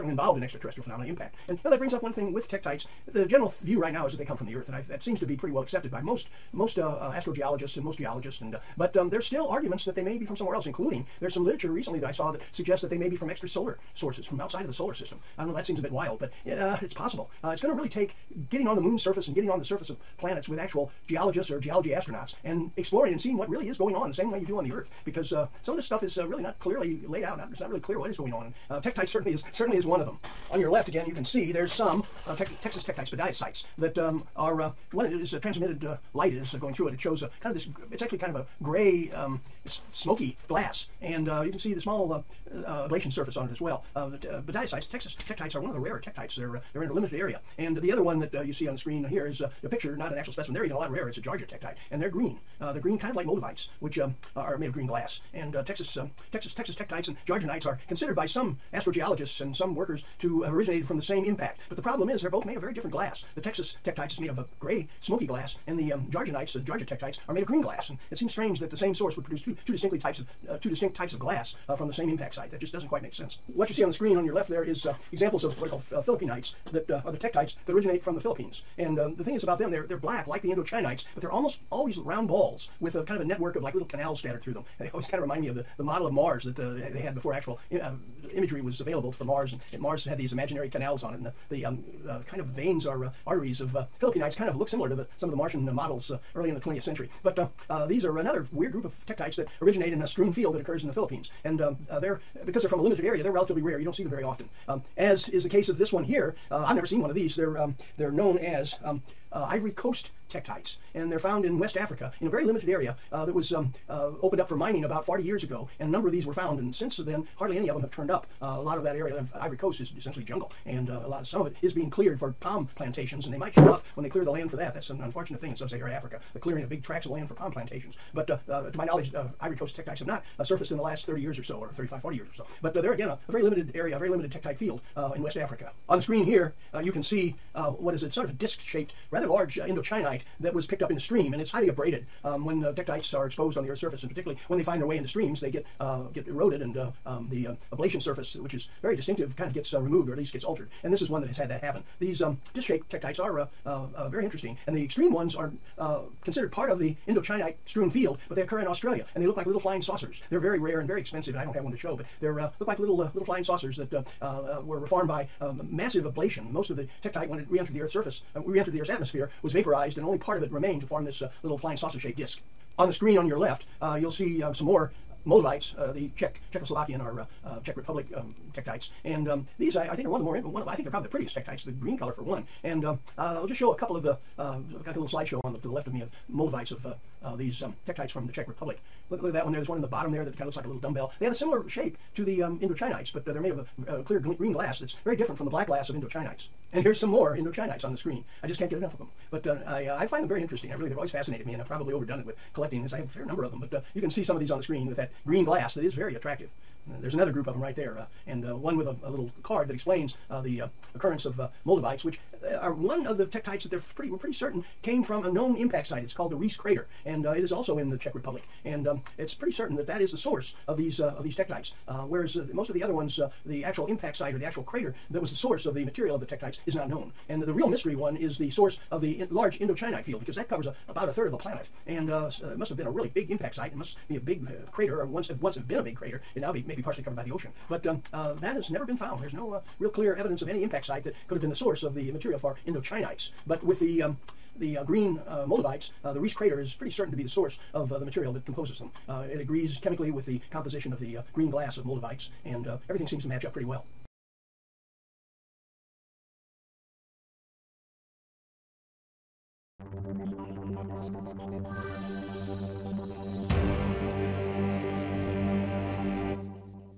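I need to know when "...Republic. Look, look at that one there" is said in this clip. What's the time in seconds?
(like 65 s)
188 s.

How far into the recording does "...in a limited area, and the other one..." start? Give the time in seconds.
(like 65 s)
46 s.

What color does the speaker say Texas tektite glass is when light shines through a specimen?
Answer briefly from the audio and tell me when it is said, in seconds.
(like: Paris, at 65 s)
gray, smoky, at 64 s.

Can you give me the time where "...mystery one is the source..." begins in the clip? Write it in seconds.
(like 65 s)
227 s.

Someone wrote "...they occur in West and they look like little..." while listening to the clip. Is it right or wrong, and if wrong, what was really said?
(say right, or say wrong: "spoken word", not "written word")
wrong: "Australia", not "West".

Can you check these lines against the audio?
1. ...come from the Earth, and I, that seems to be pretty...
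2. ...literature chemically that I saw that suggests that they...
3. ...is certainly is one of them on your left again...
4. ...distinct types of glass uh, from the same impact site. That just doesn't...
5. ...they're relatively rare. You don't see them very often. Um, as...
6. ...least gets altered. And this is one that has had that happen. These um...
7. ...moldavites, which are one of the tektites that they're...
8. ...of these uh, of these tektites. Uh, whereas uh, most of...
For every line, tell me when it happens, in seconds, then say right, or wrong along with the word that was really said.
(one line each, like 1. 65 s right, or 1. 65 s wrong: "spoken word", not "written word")
1. 4 s right
2. 11 s wrong: "recently", not "chemically"
3. 29 s right
4. 70 s right
5. 103 s right
6. 150 s right
7. 211 s right
8. 220 s right.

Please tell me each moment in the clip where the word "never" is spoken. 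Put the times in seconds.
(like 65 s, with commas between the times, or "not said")
106 s, 238 s.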